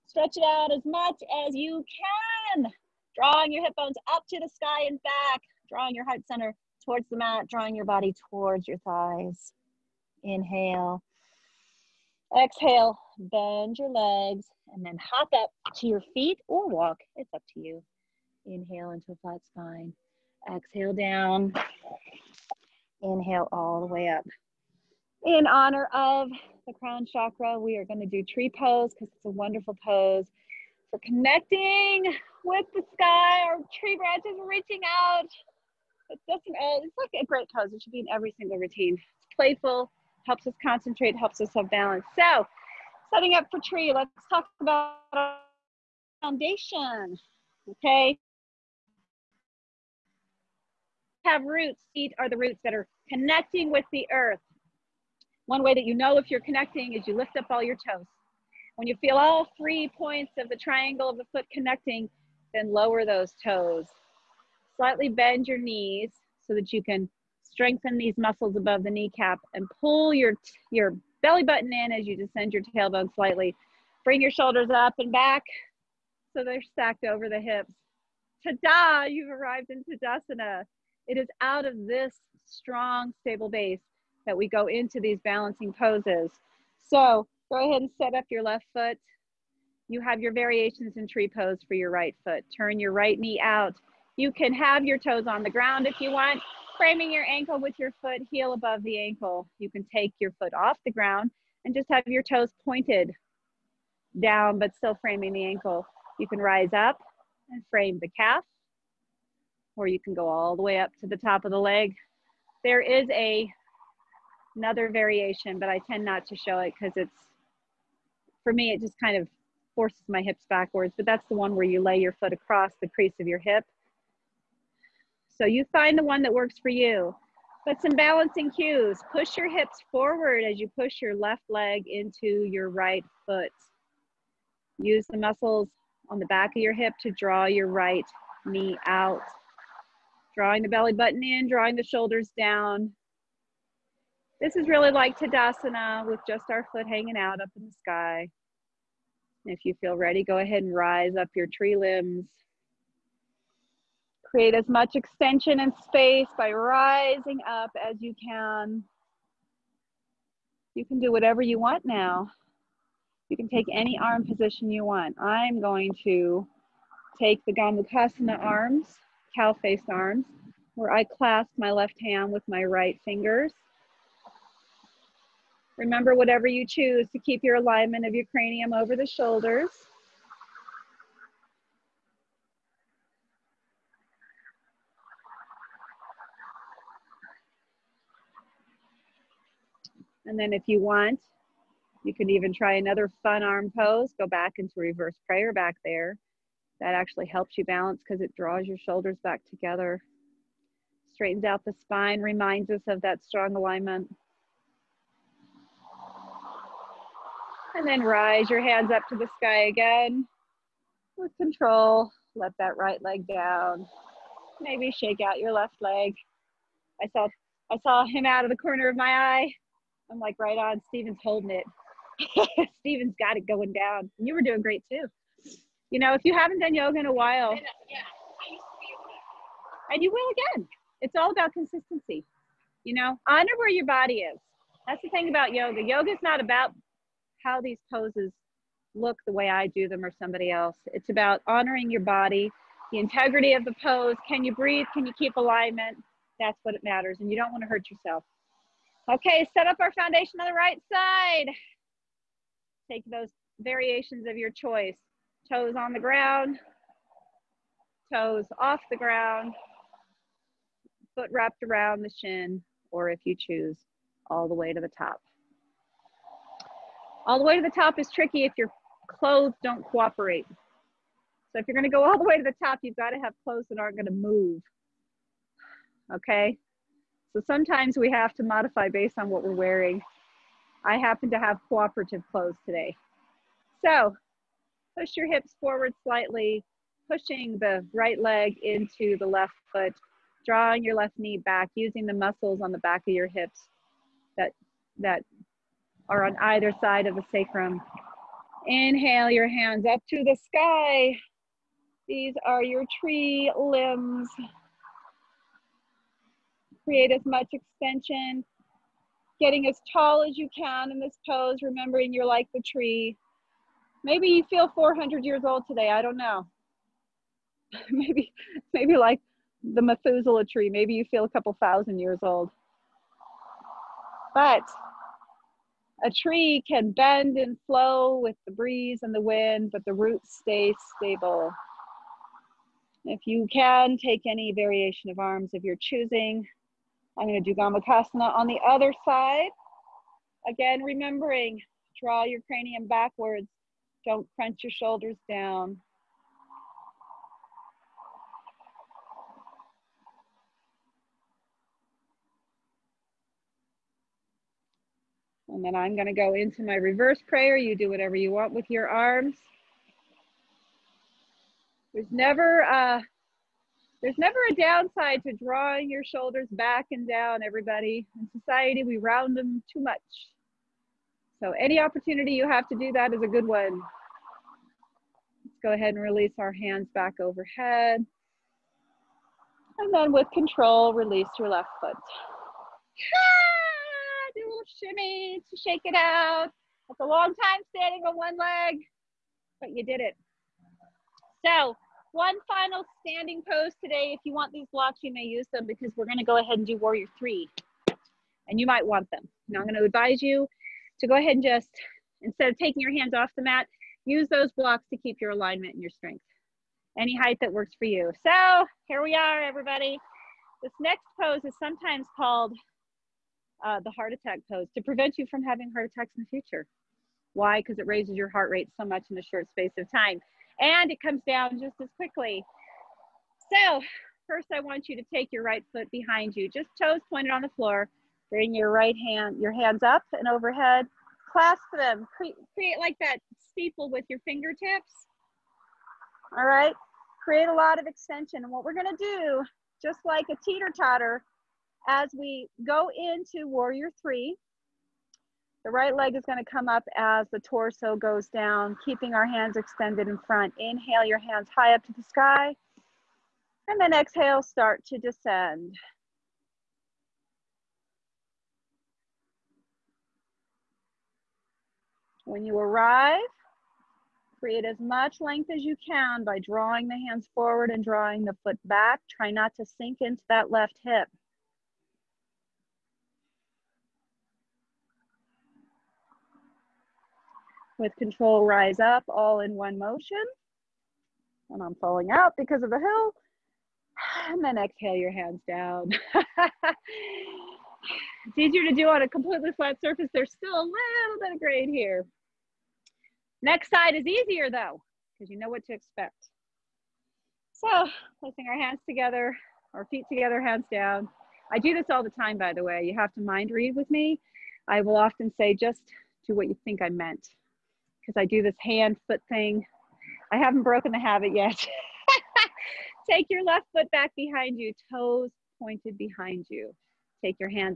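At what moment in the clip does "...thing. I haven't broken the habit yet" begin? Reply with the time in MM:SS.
08:29.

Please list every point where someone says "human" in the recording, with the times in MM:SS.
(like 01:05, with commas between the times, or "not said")
not said.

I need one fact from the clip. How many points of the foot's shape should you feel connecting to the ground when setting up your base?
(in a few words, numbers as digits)
3.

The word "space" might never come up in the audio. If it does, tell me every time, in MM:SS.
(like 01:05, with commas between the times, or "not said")
02:35, 06:59.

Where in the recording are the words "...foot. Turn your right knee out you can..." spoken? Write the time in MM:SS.
01:32.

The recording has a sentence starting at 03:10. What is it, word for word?
And then if you want, you can even try another fun arm pose.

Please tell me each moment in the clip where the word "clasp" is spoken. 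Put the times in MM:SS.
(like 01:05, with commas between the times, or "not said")
02:51, 07:11.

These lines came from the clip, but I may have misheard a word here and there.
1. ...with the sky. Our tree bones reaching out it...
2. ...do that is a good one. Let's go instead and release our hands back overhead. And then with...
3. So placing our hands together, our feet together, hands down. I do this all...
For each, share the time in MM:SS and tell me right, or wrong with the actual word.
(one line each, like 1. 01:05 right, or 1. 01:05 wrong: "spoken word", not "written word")
1. 00:32 wrong: "branches", not "bones"
2. 06:12 wrong: "ahead", not "instead"
3. 08:17 right.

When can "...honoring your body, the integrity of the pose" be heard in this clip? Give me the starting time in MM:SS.
04:01.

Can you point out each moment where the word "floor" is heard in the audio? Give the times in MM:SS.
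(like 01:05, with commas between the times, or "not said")
07:07.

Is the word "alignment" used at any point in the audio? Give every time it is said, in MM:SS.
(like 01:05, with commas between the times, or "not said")
02:57, 03:23, 04:05, 06:45.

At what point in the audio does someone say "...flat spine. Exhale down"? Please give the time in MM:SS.
00:19.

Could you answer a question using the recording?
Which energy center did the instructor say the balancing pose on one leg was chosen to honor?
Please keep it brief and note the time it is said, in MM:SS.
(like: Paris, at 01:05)
Crown chakra, at 00:26.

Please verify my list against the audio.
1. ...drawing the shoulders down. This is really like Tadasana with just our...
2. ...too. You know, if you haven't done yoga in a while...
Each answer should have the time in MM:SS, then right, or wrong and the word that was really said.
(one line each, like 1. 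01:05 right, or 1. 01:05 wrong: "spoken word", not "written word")
1. 02:21 right
2. 03:44 right.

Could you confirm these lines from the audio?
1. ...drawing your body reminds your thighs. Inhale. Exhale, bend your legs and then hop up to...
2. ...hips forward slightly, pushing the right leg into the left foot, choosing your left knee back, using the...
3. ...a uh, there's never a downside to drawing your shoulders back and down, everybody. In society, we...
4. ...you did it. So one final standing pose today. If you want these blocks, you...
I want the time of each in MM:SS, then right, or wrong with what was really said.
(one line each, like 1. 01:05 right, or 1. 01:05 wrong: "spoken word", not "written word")
1. 00:07 wrong: "towards", not "reminds"
2. 04:45 wrong: "drawing", not "choosing"
3. 06:02 right
4. 06:29 right.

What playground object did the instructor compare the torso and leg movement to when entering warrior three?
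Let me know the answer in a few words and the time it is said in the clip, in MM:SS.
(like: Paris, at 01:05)
Teeter-totter, at 07:20.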